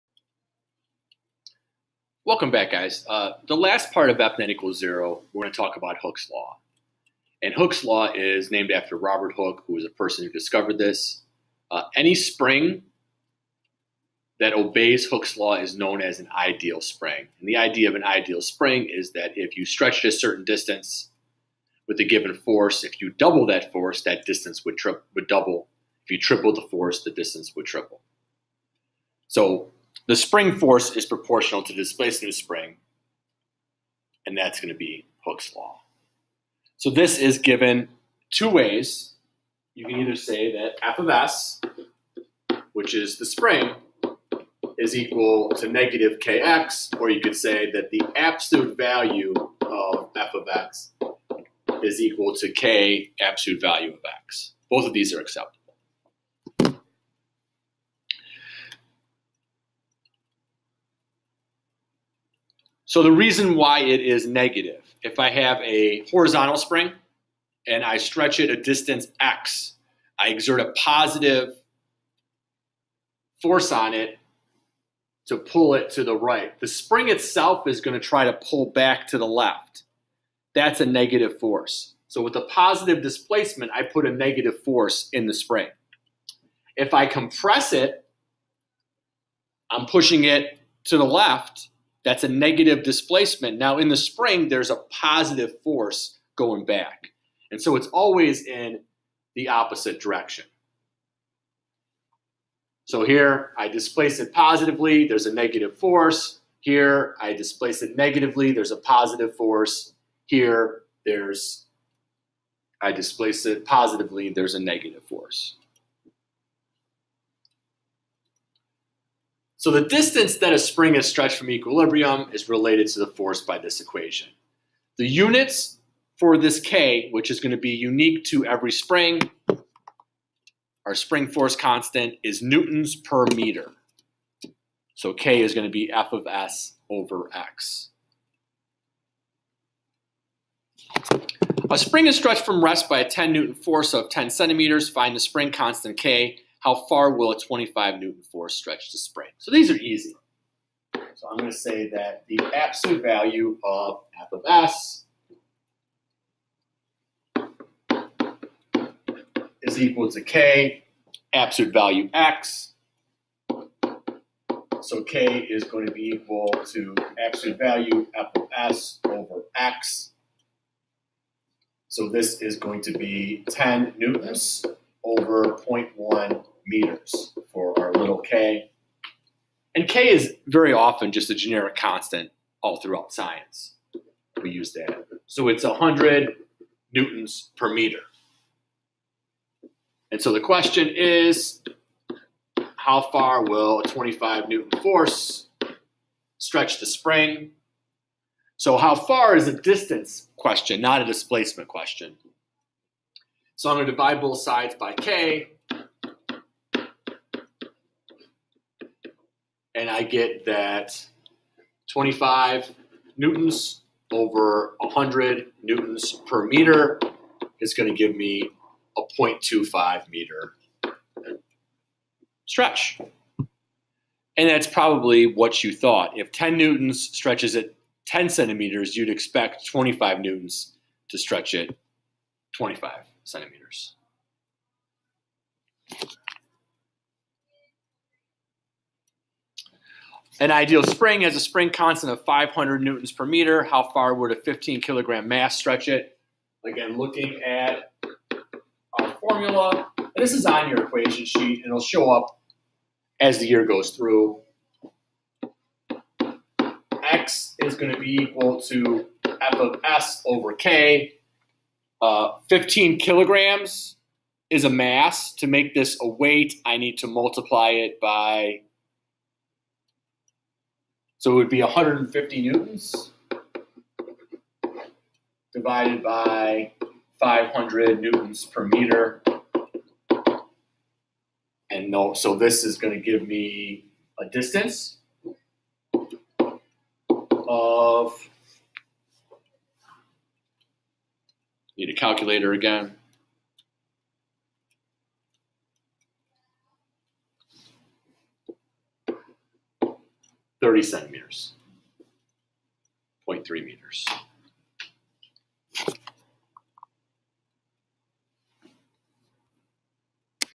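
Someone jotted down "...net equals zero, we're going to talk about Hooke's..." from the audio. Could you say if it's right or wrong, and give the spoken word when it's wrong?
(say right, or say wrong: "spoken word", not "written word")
right.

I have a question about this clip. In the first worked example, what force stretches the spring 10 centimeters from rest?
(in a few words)
10 newtons.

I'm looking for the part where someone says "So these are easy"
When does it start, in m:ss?
2:29.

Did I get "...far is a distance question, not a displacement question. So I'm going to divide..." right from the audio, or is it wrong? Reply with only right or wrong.
right.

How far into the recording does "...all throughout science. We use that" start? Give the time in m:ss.
3:02.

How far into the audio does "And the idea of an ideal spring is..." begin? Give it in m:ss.
0:17.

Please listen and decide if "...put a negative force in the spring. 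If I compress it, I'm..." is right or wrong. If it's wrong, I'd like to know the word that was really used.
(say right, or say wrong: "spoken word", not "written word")
right.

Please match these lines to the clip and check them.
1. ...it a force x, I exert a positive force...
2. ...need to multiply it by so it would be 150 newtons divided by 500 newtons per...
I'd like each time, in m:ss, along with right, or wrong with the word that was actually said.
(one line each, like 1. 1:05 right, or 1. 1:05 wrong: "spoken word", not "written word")
1. 1:08 wrong: "distance", not "force"
2. 4:26 right.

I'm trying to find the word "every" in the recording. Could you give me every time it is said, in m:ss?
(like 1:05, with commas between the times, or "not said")
2:08.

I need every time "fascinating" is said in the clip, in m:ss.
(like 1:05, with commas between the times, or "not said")
not said.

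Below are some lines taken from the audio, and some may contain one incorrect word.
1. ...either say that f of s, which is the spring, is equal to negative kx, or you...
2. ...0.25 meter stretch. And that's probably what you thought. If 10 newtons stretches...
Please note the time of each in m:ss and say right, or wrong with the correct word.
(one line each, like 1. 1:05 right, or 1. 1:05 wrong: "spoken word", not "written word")
1. 0:40 right
2. 3:39 right.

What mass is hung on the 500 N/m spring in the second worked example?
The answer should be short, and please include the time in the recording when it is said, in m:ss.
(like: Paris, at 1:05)
15 kilograms, at 4:04.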